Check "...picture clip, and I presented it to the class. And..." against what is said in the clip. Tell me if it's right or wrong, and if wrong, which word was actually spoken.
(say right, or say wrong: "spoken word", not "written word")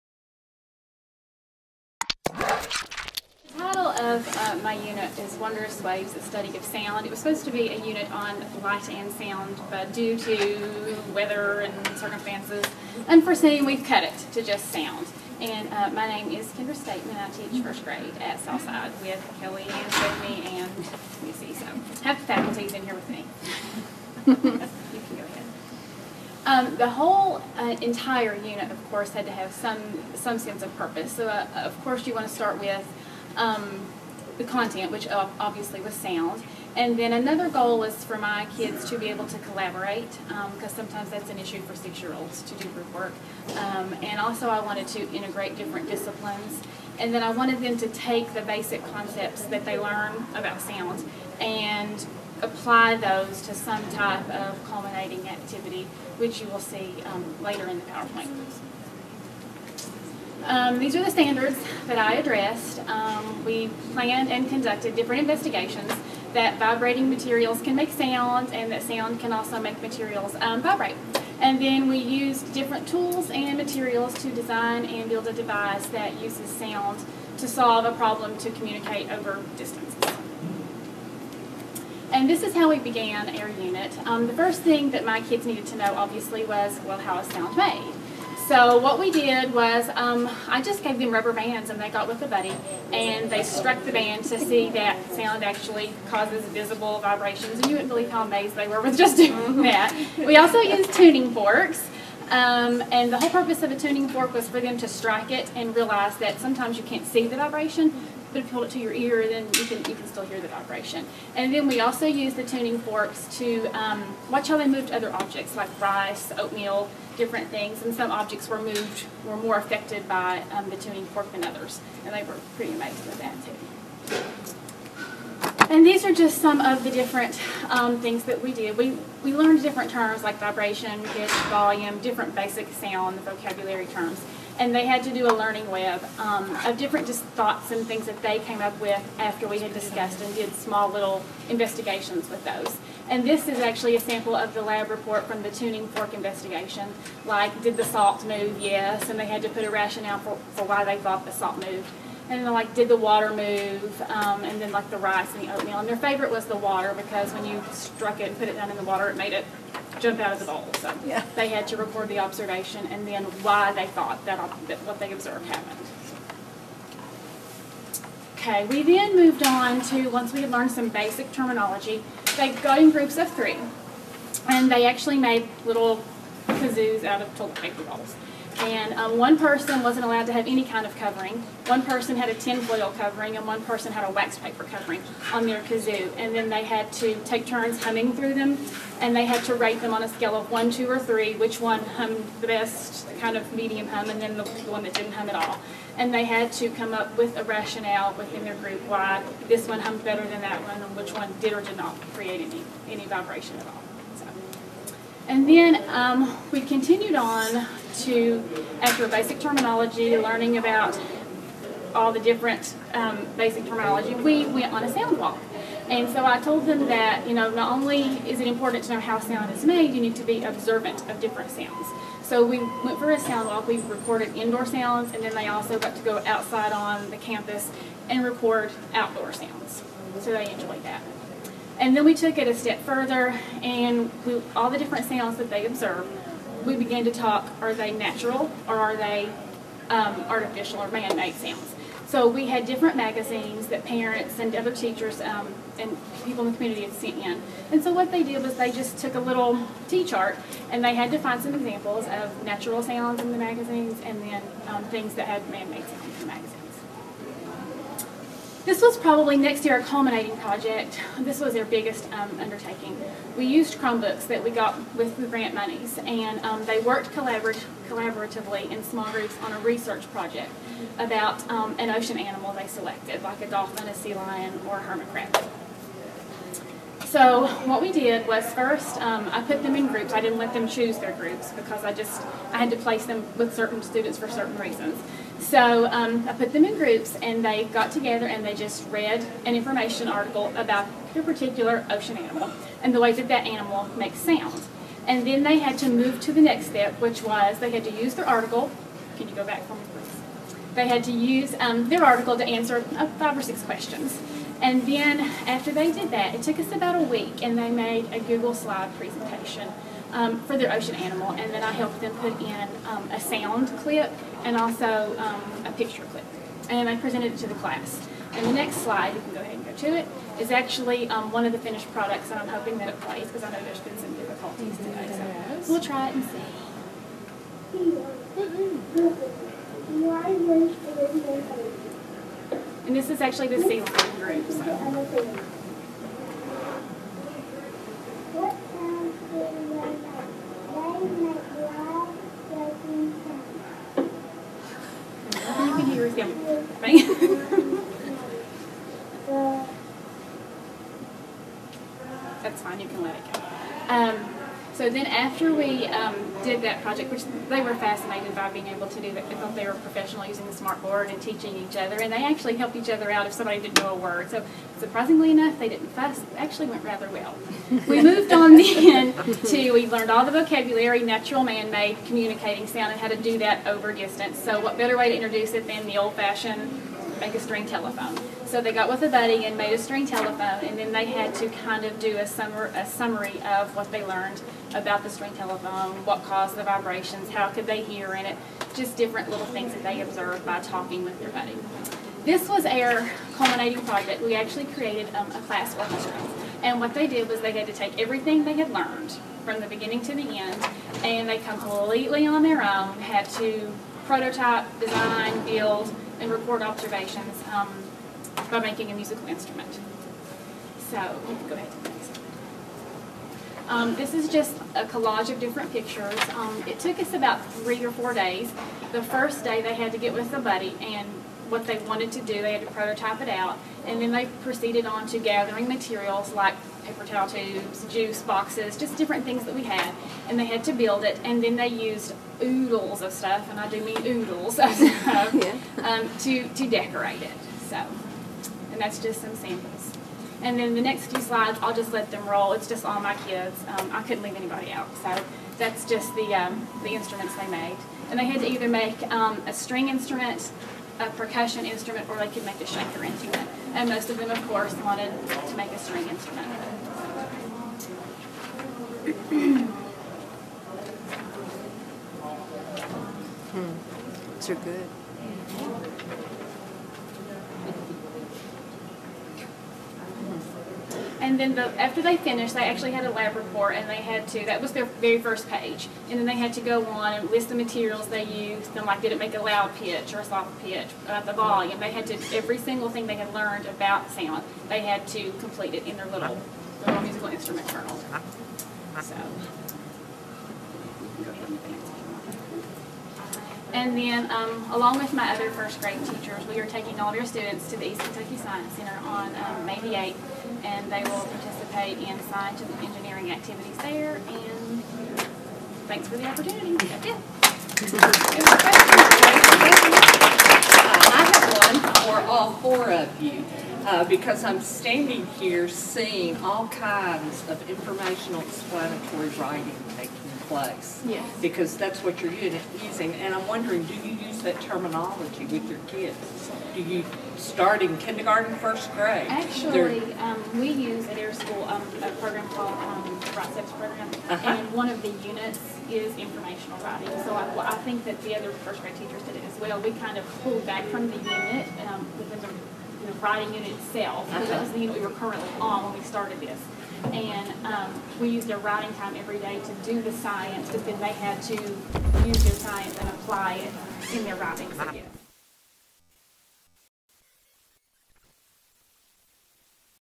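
right.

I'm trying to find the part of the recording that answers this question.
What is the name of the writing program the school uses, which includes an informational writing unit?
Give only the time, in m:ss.
8:53.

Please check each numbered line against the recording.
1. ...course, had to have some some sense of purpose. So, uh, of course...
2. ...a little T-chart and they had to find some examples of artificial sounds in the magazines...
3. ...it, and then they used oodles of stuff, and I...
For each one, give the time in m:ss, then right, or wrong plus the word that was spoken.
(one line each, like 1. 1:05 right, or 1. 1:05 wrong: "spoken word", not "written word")
1. 0:28 right
2. 4:09 wrong: "natural", not "artificial"
3. 7:11 right.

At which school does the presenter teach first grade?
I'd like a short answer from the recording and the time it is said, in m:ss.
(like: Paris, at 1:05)
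Southside, at 0:18.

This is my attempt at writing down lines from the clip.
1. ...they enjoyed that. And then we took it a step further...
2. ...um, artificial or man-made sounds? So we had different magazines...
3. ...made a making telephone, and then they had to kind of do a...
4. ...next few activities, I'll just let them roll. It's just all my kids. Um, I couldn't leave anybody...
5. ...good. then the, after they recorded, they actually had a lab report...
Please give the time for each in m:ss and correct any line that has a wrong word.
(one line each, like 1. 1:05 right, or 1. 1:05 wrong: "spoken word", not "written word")
1. 3:50 right
2. 3:59 right
3. 6:19 wrong: "string", not "making"
4. 7:20 wrong: "slides", not "activities"
5. 7:44 wrong: "finished", not "recorded".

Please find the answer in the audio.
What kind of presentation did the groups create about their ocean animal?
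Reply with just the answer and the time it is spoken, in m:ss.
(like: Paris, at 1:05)
Google slide presentation, at 5:08.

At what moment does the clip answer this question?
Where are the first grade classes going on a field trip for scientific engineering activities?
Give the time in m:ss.
8:17.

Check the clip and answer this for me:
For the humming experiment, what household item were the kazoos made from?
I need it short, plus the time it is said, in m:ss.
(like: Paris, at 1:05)
toilet paper rolls, at 2:57.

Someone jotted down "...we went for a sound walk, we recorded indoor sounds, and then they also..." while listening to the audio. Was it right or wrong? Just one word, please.
right.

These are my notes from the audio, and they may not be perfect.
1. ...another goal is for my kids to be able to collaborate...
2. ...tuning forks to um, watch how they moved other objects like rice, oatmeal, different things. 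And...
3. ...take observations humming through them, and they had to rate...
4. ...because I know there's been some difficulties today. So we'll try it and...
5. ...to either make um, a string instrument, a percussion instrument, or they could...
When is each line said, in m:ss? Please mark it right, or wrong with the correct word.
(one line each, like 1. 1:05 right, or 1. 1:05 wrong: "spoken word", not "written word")
1. 0:37 right
2. 1:52 right
3. 3:07 wrong: "turns", not "observations"
4. 5:23 right
5. 7:28 right.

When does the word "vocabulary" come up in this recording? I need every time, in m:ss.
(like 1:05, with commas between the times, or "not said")
2:13, 6:10.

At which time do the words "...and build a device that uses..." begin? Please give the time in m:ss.
1:14.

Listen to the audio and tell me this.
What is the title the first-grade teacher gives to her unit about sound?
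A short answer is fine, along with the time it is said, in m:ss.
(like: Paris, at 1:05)
Wondrous Waves, at 0:05.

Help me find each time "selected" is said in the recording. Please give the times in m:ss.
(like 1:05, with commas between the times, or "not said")
4:32.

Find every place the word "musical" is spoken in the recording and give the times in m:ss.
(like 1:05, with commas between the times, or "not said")
6:48, 8:07.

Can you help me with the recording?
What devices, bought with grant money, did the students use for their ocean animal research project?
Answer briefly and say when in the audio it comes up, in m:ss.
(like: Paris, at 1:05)
Chromebooks, at 4:23.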